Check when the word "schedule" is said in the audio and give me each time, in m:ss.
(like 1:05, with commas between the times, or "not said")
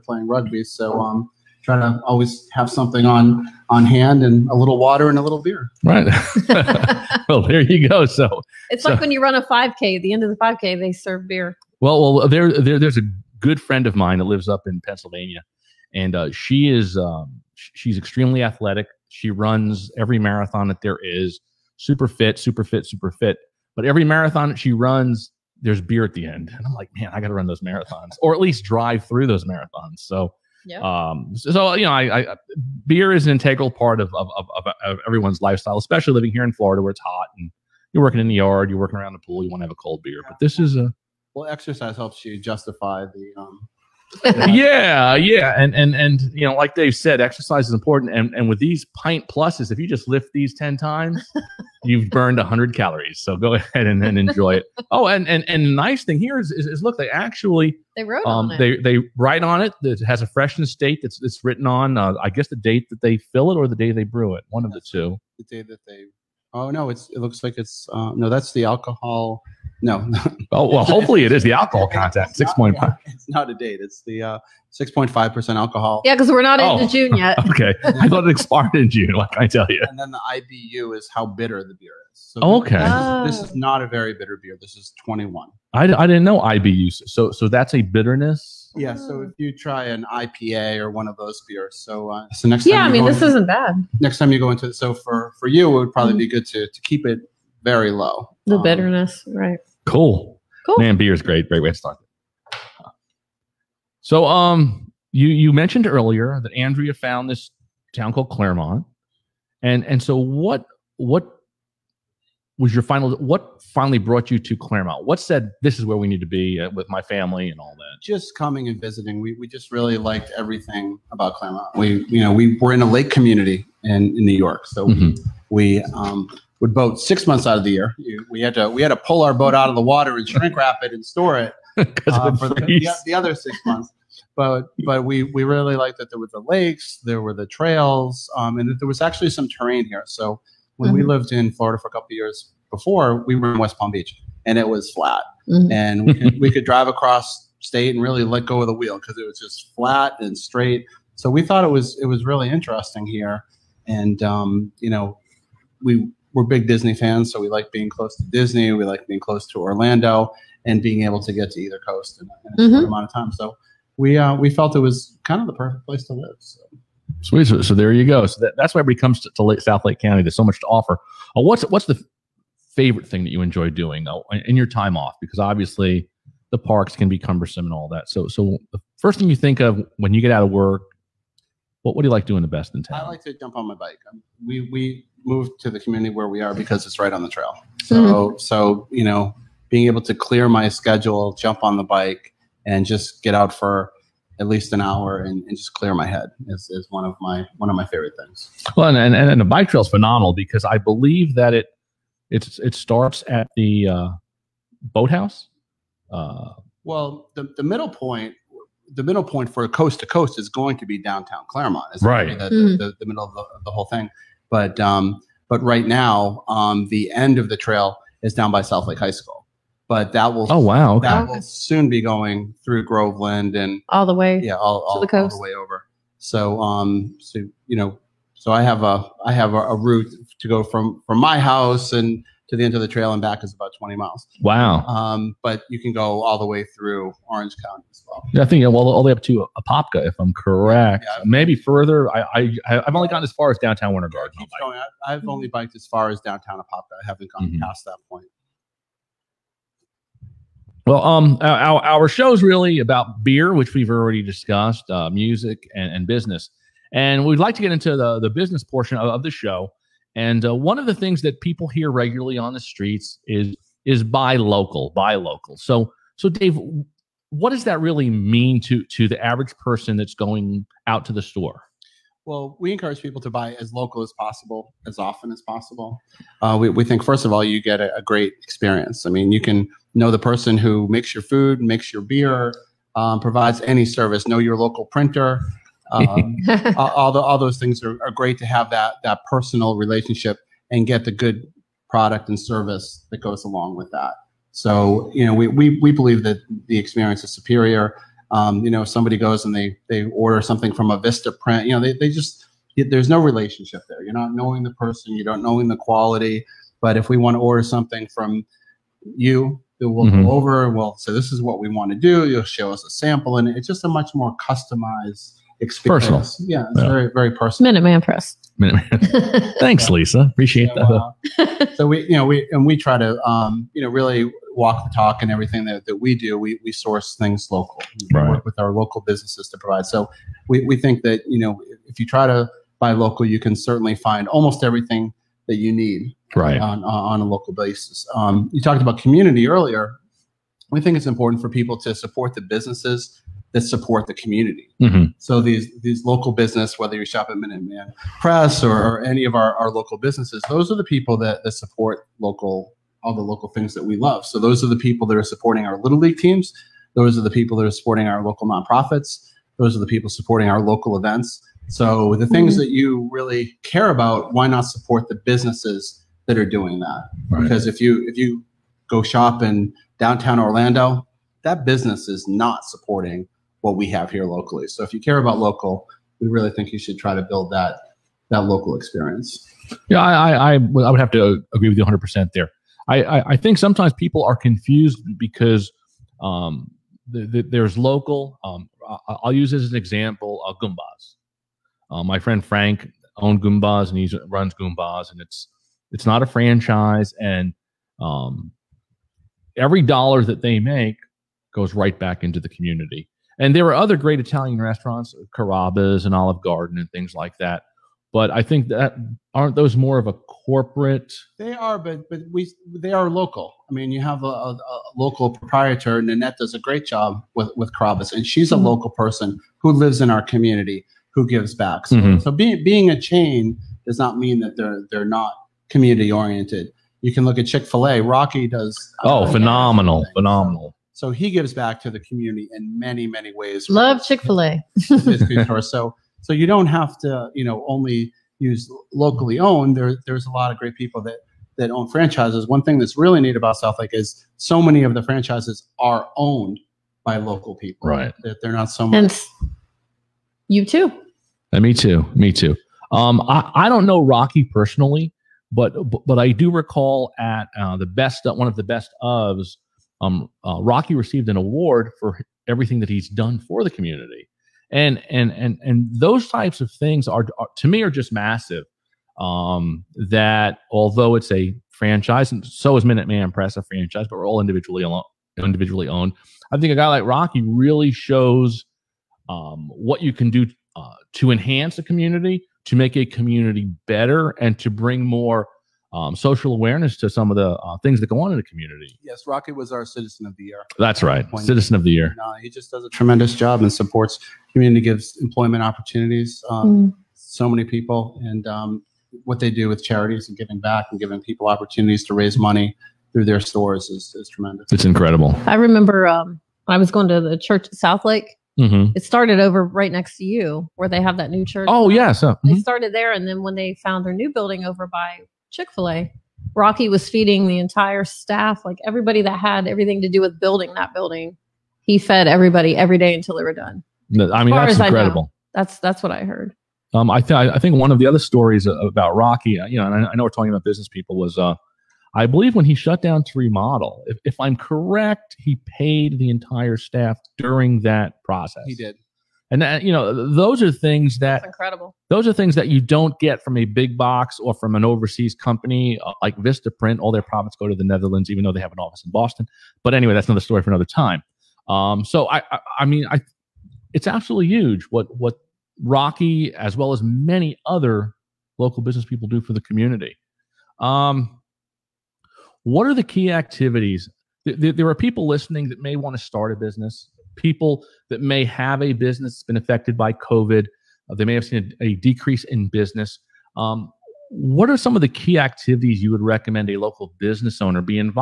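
3:10.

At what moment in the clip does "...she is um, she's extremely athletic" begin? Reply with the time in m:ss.
0:16.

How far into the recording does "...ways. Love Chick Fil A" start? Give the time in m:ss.
7:13.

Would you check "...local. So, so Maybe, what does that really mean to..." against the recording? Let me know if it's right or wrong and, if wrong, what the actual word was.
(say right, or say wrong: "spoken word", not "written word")
wrong: "Dave", not "Maybe".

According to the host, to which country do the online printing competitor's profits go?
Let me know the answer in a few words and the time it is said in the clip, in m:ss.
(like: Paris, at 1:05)
the Netherlands, at 9:07.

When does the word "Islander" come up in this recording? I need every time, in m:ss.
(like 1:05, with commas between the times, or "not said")
not said.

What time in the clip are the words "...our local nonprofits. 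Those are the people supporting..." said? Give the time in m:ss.
5:58.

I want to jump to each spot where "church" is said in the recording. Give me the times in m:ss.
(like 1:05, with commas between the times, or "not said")
8:27, 8:31.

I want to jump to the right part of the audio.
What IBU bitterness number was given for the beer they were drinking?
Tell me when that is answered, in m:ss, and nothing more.
1:25.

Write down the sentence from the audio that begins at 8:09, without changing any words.
Yes, Rocky was our Citizen of the Year.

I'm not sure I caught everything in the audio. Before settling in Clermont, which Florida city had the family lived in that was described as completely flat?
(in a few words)
West Palm Beach.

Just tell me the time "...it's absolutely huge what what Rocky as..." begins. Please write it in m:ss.
9:13.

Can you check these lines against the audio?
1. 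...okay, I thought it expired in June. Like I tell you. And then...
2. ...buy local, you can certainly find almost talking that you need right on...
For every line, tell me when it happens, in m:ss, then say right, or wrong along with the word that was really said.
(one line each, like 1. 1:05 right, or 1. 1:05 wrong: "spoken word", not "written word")
1. 1:17 right
2. 5:32 wrong: "everything", not "talking".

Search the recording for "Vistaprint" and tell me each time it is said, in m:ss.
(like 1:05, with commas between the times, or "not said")
5:00, 9:06.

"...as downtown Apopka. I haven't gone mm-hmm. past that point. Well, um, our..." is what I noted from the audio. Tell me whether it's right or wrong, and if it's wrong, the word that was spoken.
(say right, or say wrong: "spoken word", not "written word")
right.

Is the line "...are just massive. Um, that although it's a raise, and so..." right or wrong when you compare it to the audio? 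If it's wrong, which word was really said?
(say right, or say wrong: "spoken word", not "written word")
wrong: "franchise", not "raise".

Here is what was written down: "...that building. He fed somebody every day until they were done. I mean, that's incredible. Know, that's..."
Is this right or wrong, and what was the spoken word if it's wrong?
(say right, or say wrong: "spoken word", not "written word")
wrong: "everybody", not "somebody".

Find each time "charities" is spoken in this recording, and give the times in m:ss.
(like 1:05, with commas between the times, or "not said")
8:19.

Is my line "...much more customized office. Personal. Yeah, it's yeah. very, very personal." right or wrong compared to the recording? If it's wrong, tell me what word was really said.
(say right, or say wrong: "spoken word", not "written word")
wrong: "experience", not "office".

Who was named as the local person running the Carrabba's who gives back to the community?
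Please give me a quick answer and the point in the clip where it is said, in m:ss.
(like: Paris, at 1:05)
Nanette, at 6:56.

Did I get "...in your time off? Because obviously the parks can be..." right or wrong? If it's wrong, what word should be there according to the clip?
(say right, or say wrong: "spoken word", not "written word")
right.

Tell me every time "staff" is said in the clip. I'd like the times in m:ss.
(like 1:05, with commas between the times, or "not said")
8:38, 8:56.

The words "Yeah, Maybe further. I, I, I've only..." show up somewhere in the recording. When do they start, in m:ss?
4:01.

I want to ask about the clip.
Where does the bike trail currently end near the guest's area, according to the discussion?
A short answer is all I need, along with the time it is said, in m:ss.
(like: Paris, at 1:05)
South Lake High School, at 3:38.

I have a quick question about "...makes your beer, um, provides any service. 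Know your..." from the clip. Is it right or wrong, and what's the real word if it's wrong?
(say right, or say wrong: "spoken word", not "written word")
right.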